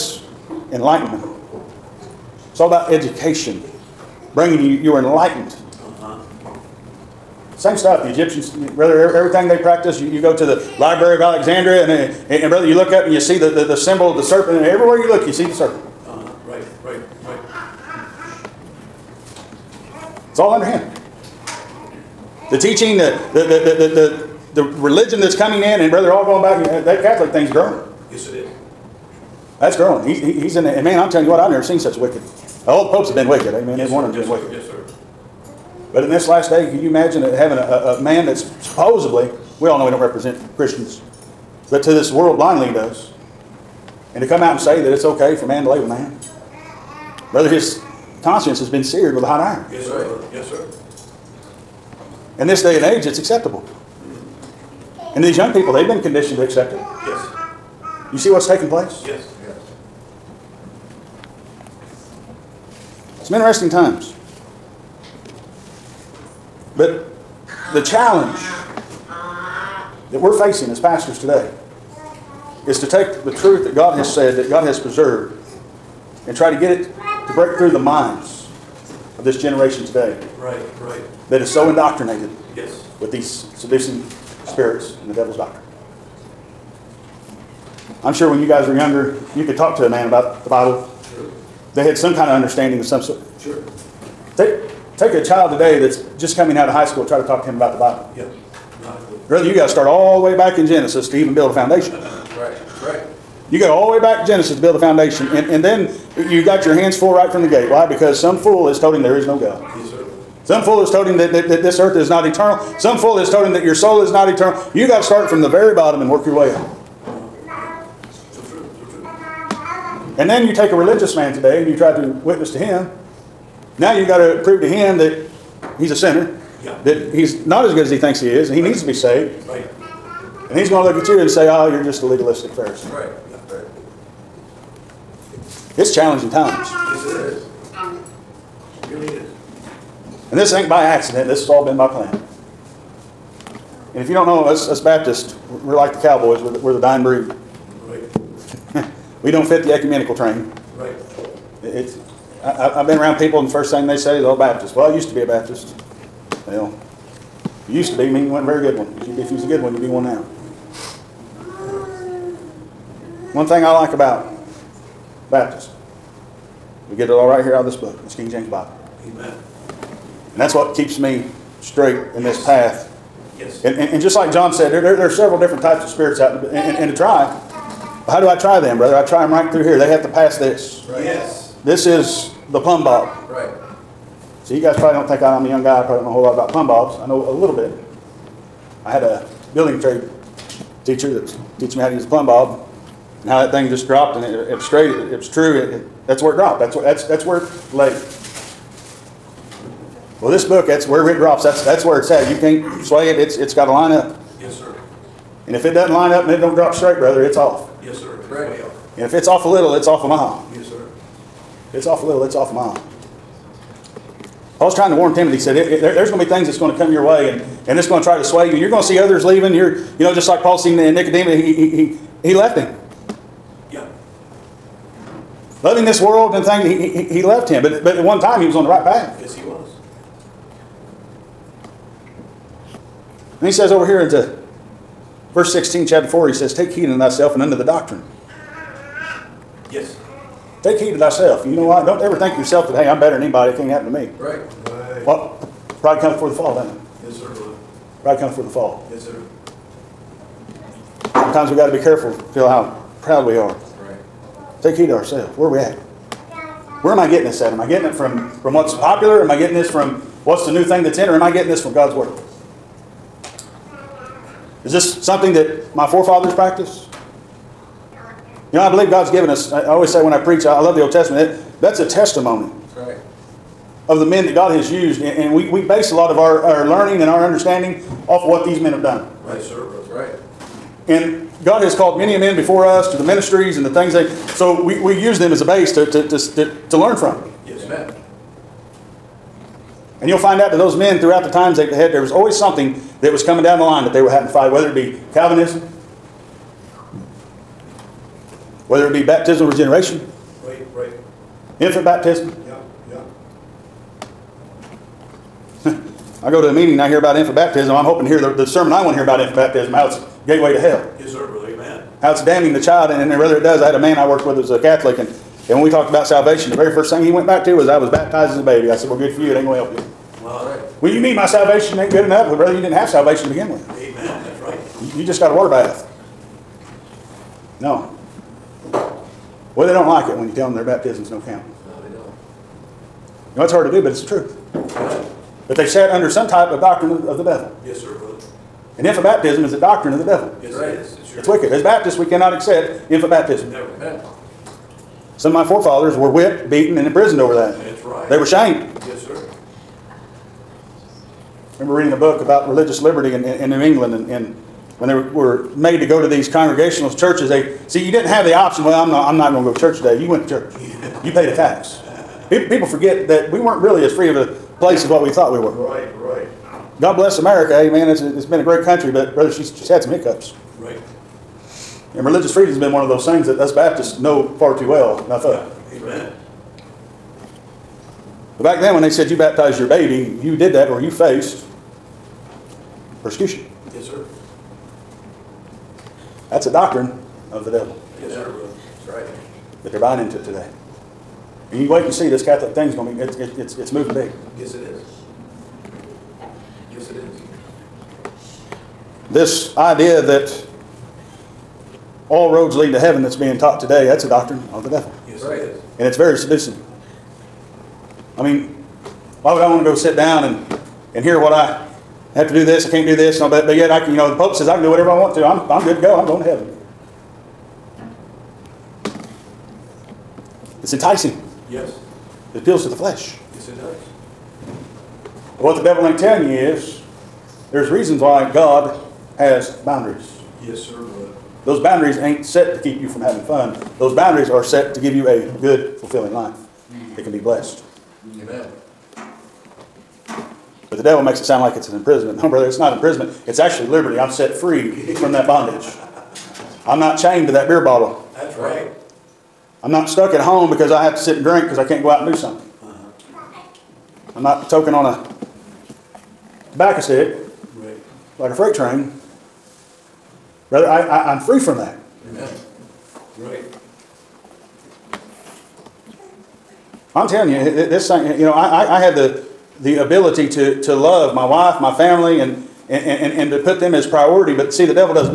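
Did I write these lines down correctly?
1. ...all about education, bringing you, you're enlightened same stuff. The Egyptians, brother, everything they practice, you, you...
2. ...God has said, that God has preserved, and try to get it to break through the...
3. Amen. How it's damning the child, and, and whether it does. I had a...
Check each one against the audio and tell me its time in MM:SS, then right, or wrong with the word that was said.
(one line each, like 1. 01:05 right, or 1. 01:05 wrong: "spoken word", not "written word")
1. 00:02 right
2. 01:13 right
3. 05:11 right.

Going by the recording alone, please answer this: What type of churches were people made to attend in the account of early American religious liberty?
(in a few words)
Congregationalist churches.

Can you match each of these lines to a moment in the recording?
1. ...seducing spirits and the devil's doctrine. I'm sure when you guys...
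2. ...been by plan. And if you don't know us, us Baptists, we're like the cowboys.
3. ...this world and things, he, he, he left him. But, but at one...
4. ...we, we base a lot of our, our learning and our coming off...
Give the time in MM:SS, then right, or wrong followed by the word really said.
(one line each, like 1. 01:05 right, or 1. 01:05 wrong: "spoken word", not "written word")
1. 01:23 right
2. 02:21 right
3. 03:45 right
4. 04:35 wrong: "understanding", not "coming".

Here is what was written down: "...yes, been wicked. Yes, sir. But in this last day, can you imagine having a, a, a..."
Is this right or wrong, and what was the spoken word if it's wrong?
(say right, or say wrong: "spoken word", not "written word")
right.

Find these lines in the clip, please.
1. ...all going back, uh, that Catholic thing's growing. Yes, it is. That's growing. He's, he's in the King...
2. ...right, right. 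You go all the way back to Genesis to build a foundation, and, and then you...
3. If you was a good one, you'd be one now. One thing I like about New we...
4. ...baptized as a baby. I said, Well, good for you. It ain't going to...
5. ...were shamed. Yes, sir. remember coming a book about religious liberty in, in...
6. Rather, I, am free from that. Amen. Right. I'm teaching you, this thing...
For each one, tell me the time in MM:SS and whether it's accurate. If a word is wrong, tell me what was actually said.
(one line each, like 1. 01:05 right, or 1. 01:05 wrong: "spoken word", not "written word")
1. 00:26 wrong: "And", not "King"
2. 01:41 right
3. 02:39 wrong: "Baptists", not "New"
4. 05:17 right
5. 05:48 wrong: "reading", not "coming"
6. 07:40 wrong: "telling", not "teaching".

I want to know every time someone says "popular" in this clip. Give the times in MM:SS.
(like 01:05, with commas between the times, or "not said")
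04:18.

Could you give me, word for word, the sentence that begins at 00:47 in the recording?
Brother, his conscience has been seared with a hot iron.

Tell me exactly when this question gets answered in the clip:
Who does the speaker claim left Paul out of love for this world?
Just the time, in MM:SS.
03:40.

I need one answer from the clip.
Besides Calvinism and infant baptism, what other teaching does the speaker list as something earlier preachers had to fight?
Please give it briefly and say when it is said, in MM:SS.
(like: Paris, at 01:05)
Baptismal regeneration, at 04:59.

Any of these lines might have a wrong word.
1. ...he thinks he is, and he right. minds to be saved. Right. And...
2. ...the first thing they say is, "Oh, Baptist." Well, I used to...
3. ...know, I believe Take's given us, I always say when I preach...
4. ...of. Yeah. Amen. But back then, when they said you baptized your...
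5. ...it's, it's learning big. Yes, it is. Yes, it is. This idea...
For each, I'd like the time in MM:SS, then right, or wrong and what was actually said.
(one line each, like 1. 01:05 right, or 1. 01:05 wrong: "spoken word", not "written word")
1. 02:07 wrong: "needs", not "minds"
2. 02:33 right
3. 04:28 wrong: "God", not "Take"
4. 06:15 right
5. 06:33 wrong: "moving", not "learning".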